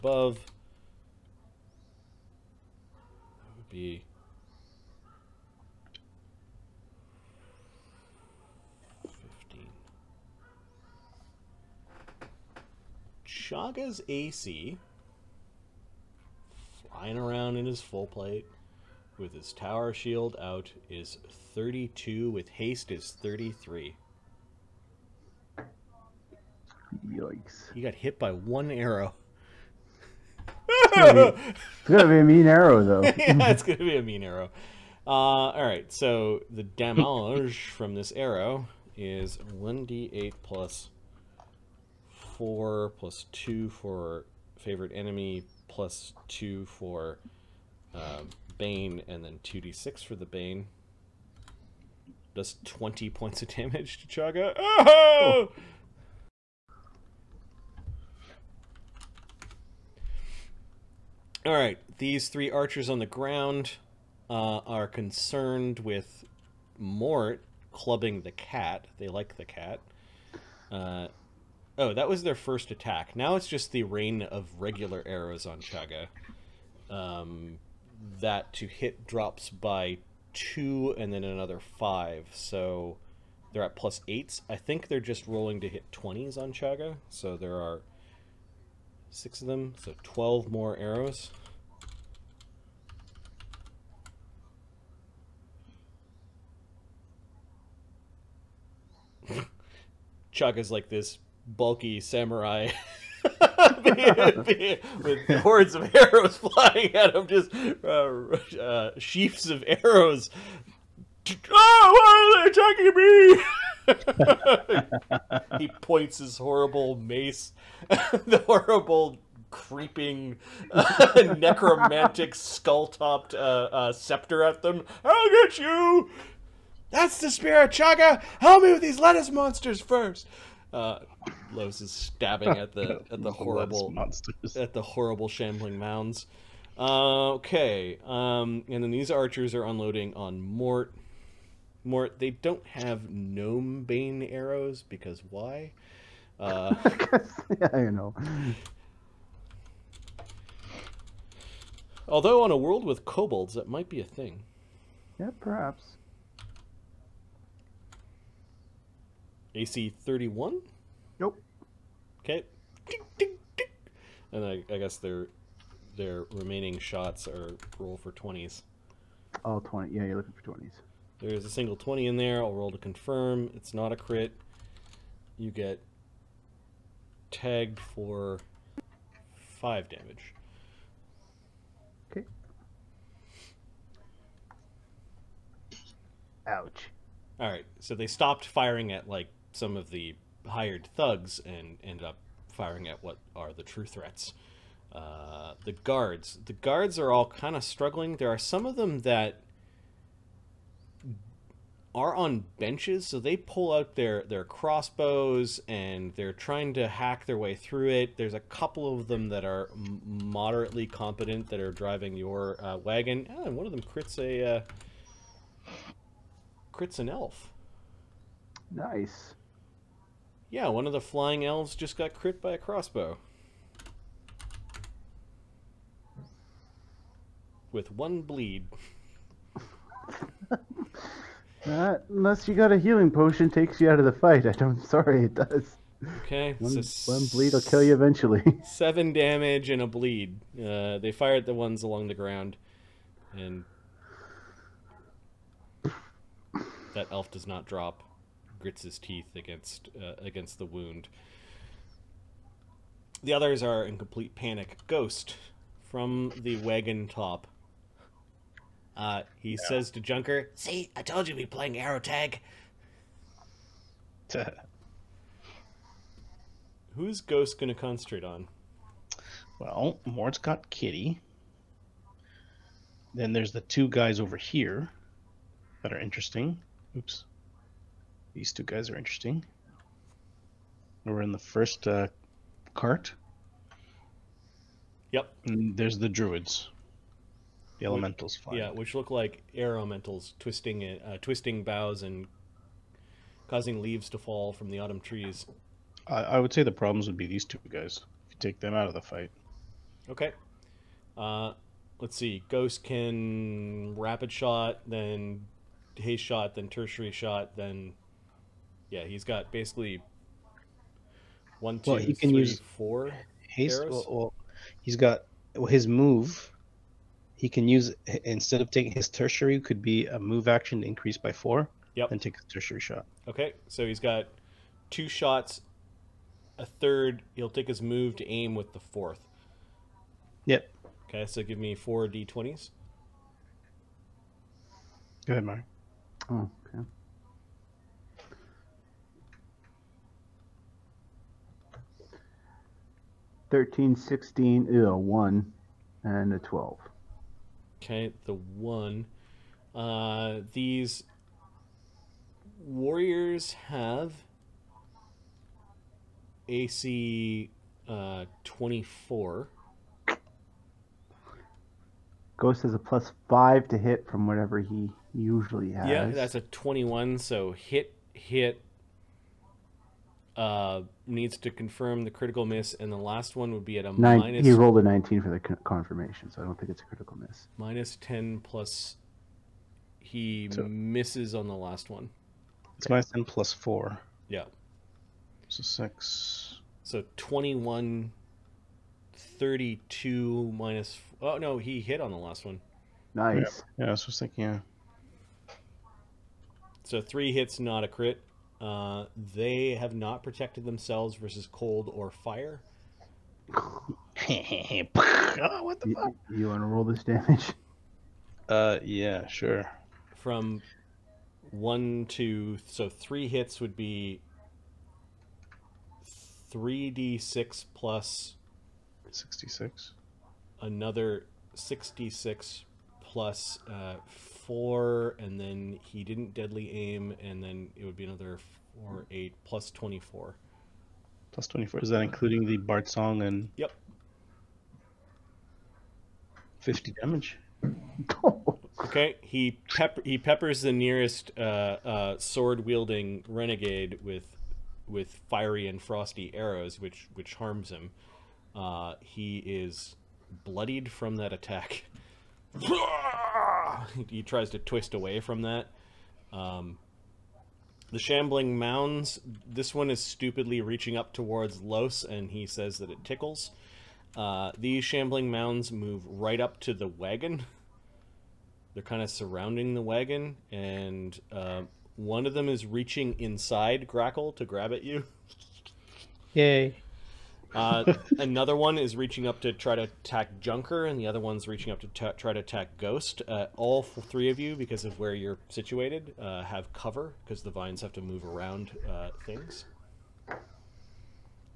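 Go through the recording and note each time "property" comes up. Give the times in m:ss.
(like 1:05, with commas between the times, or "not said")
not said.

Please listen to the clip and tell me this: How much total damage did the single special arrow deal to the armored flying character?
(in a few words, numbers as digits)
20.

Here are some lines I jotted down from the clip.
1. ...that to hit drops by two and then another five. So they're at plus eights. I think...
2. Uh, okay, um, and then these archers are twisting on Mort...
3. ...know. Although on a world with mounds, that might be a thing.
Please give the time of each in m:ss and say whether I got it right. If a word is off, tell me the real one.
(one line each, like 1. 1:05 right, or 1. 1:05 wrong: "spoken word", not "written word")
1. 1:18 right
2. 2:16 wrong: "unloading", not "twisting"
3. 2:27 wrong: "kobolds", not "mounds".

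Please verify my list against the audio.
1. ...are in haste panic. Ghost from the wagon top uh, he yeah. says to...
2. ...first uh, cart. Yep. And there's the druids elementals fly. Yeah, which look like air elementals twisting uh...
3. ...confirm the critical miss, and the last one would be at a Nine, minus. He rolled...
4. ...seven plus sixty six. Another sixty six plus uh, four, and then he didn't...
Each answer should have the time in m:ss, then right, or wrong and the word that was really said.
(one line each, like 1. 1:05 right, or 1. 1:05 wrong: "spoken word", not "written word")
1. 4:13 wrong: "complete", not "haste"
2. 4:41 right
3. 6:11 right
4. 6:57 wrong: "six", not "seven".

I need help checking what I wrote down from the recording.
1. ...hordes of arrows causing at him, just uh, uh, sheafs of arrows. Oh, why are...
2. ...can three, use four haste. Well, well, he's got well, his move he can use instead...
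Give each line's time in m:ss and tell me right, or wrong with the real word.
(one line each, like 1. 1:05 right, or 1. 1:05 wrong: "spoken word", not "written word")
1. 1:45 wrong: "flying", not "causing"
2. 5:12 right.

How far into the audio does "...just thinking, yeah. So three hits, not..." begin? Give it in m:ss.
6:34.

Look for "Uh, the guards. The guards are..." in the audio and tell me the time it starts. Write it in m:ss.
3:14.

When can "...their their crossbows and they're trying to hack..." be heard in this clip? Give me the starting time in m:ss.
3:23.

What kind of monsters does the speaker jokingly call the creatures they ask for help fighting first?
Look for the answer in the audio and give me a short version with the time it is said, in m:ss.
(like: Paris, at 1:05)
lettuce monsters, at 2:08.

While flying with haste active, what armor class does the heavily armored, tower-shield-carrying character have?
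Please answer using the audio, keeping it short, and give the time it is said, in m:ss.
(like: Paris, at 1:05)
33, at 0:23.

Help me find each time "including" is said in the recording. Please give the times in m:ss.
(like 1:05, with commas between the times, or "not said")
7:12.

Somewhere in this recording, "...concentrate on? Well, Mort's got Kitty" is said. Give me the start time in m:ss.
4:27.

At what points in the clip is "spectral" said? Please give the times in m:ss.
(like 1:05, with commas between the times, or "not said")
not said.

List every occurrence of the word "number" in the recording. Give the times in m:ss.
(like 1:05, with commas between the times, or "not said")
not said.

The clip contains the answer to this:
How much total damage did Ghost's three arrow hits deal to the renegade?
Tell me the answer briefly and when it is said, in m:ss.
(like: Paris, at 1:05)
50, at 7:16.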